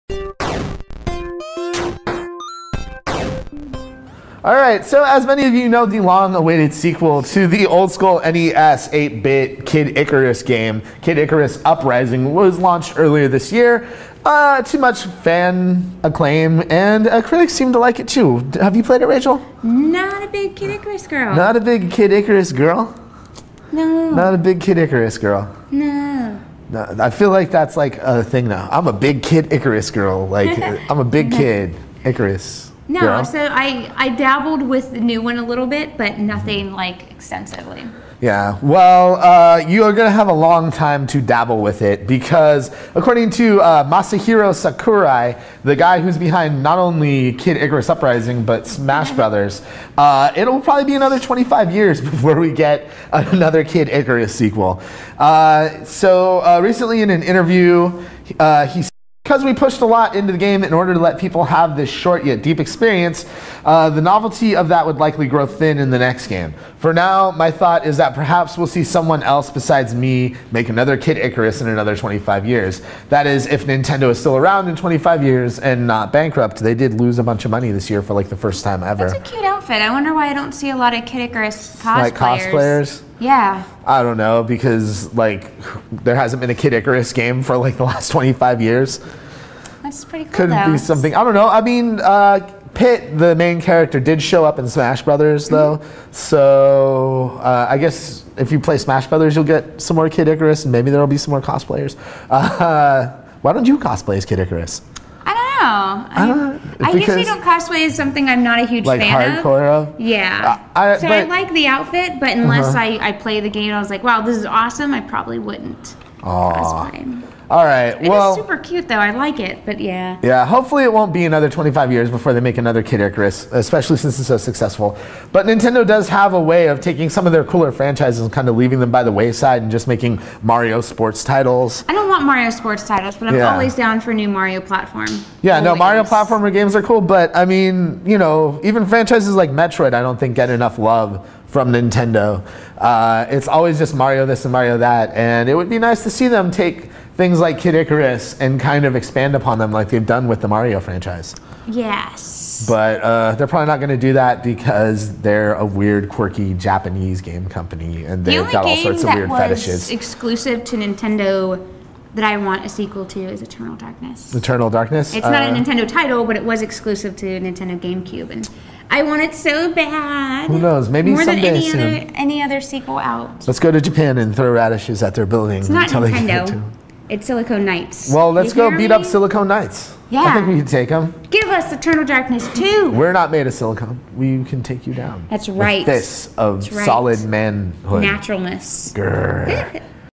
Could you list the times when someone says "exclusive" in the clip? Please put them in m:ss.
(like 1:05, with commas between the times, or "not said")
2:39, 2:46.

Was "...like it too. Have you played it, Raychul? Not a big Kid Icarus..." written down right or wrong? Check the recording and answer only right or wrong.
right.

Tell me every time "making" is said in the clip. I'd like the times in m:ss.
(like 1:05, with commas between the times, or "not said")
2:09.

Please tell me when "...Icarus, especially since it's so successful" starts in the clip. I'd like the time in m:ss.
2:03.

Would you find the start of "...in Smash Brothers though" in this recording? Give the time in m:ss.
1:34.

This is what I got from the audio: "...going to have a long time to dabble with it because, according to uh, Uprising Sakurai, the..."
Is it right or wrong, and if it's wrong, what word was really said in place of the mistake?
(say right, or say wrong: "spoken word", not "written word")
wrong: "Masahiro", not "Uprising".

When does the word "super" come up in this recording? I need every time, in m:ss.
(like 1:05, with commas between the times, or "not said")
1:58.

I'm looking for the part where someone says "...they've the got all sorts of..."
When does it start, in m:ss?
2:38.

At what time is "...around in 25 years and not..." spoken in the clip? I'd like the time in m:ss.
1:14.